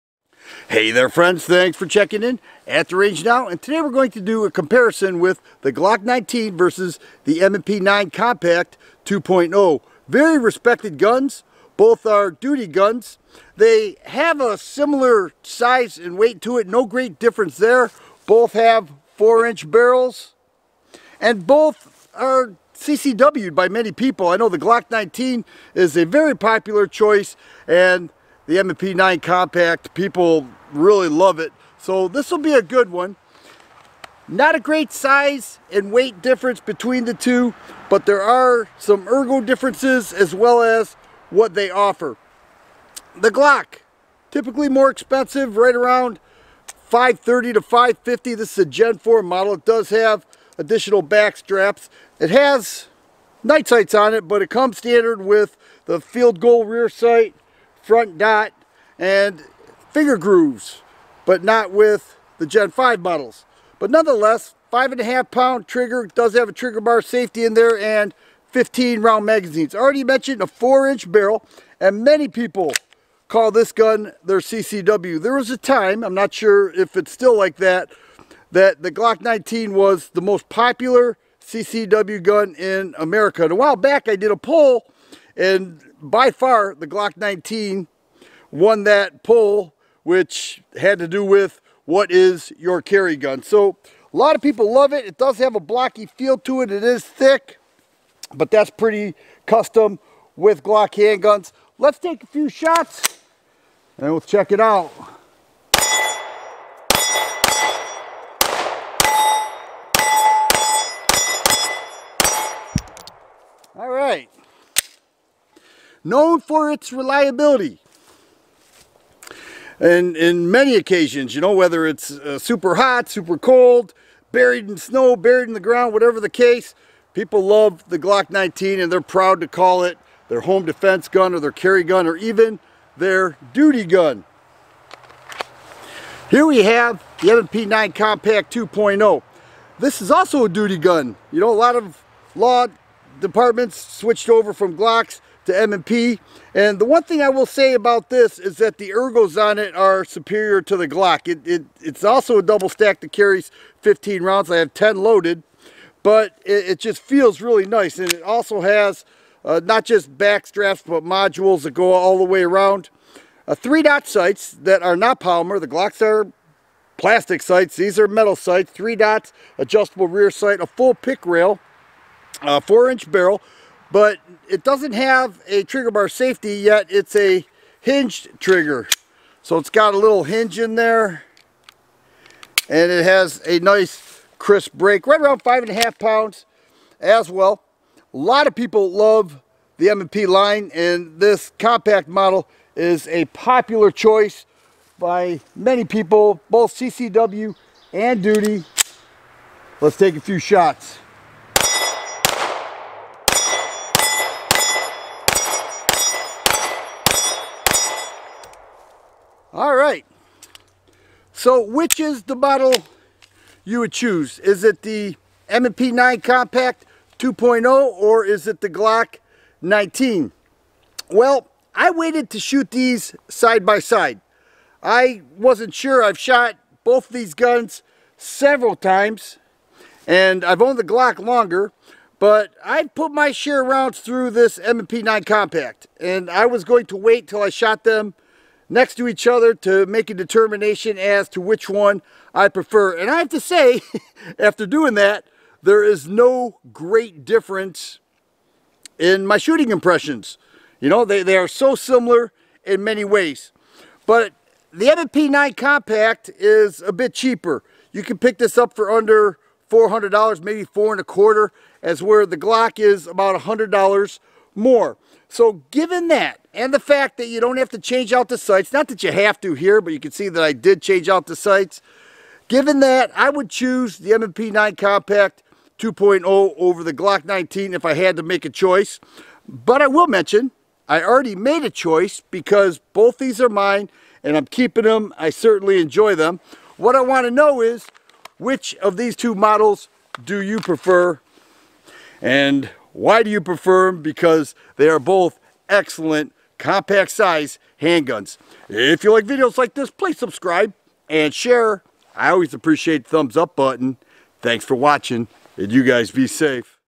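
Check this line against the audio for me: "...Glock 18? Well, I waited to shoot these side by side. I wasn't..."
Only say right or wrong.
wrong.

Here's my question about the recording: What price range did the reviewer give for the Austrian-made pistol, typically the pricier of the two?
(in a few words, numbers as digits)
530 to 550.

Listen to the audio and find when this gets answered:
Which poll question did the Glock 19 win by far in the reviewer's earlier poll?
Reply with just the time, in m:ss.
1:31.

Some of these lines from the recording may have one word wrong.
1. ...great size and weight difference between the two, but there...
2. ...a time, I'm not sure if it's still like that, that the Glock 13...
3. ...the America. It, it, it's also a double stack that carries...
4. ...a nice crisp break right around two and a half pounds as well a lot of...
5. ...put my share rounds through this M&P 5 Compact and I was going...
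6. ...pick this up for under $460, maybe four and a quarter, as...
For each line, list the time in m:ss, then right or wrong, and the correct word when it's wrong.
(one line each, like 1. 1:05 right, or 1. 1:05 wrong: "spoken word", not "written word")
1. 0:34 right
2. 1:15 wrong: "19", not "13"
3. 2:30 wrong: "Glock", not "America"
4. 3:03 wrong: "five", not "two"
5. 3:52 wrong: "9", not "5"
6. 4:18 wrong: "400", not "460".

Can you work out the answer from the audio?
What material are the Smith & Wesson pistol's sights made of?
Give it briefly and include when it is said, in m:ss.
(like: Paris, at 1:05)
metal, at 2:48.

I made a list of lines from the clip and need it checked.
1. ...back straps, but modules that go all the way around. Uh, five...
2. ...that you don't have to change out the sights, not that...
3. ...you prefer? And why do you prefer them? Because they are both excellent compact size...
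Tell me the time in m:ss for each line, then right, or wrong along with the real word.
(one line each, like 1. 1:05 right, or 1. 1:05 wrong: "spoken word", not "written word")
1. 2:40 wrong: "three", not "five"
2. 4:27 right
3. 4:50 right.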